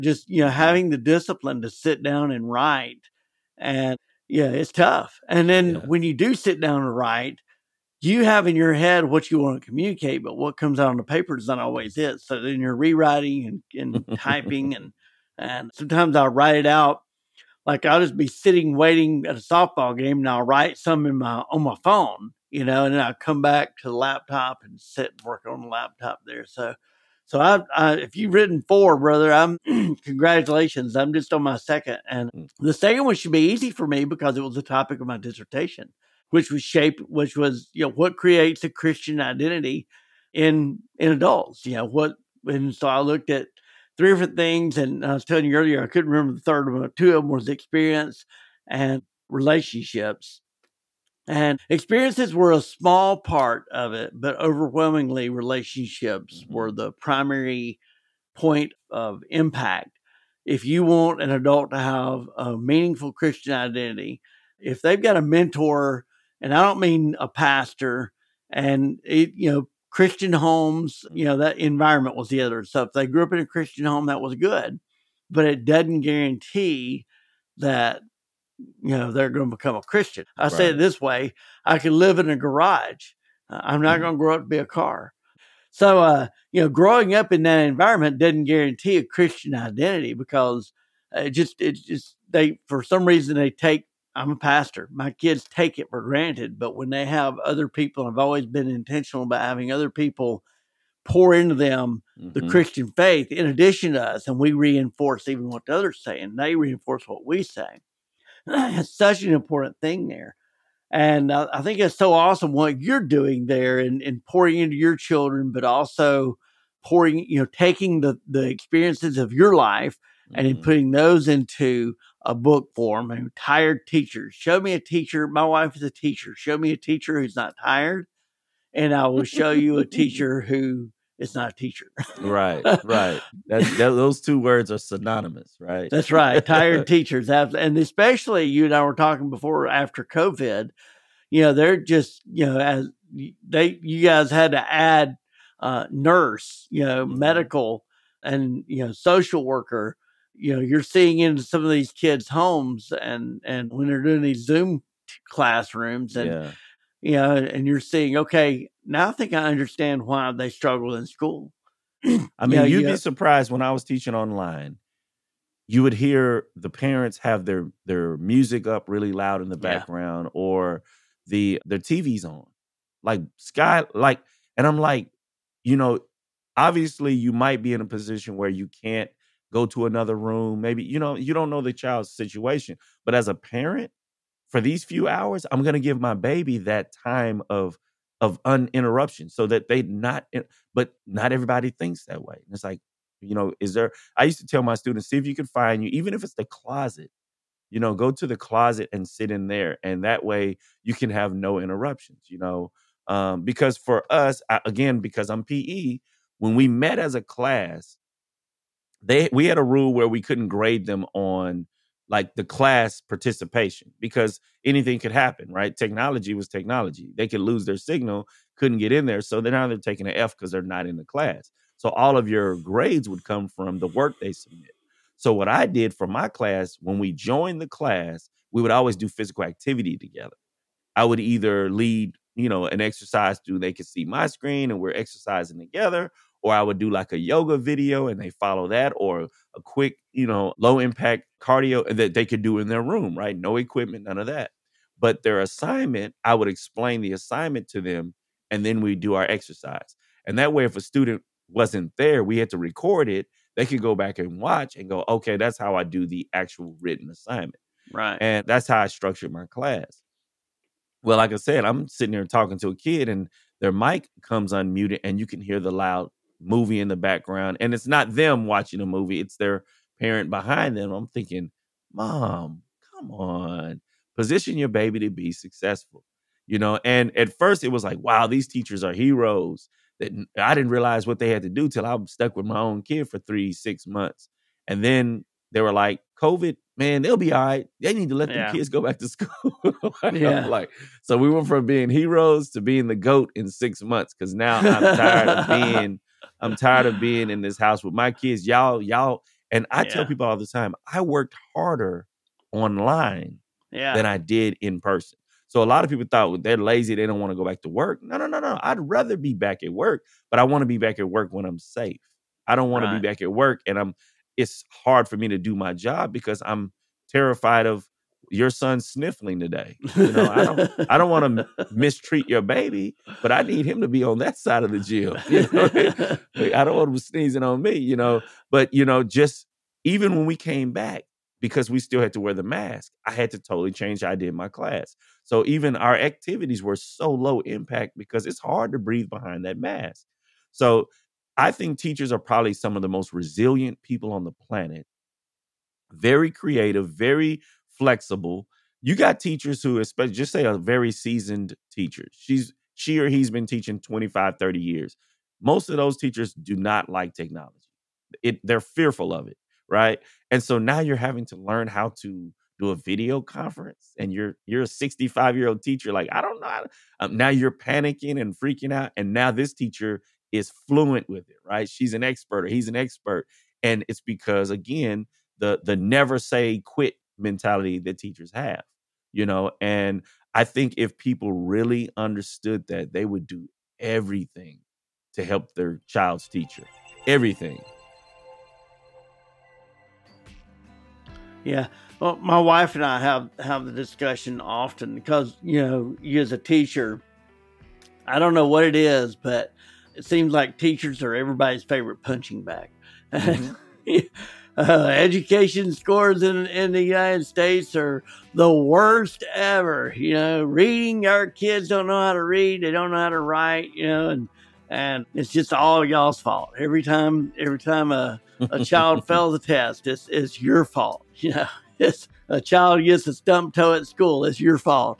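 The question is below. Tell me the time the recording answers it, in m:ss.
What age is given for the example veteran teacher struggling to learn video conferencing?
6:04.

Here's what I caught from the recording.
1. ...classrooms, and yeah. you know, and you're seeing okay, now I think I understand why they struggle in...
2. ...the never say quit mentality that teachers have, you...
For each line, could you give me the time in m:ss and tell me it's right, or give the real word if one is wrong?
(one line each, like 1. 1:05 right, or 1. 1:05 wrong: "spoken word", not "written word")
1. 2:35 right
2. 6:15 right.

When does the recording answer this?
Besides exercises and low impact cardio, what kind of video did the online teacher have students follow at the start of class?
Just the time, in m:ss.
3:57.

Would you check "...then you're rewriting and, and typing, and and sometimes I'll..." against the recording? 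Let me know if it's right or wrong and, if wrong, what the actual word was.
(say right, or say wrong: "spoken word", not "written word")
right.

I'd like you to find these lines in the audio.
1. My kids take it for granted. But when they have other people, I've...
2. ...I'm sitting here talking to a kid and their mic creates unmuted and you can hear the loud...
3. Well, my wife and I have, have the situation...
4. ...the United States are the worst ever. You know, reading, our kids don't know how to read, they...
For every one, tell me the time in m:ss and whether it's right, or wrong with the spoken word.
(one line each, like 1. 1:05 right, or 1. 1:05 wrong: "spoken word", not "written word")
1. 1:34 right
2. 4:21 wrong: "comes", not "creates"
3. 6:31 wrong: "discussion", not "situation"
4. 6:46 right.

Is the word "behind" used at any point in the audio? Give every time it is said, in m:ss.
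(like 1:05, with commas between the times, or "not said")
4:30, 5:39.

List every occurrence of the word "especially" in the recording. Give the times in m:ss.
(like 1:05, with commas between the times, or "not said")
2:17, 5:49.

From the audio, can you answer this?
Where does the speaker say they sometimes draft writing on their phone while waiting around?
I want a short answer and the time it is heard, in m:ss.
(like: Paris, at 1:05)
softball game, at 0:19.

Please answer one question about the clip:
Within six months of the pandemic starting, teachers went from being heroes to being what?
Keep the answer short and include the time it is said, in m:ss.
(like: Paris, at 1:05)
the goat, at 4:52.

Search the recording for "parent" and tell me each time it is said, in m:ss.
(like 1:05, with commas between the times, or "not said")
2:46, 3:03, 4:29.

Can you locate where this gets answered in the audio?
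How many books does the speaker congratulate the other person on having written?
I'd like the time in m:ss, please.
0:28.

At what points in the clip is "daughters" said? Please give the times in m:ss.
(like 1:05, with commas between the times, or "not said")
not said.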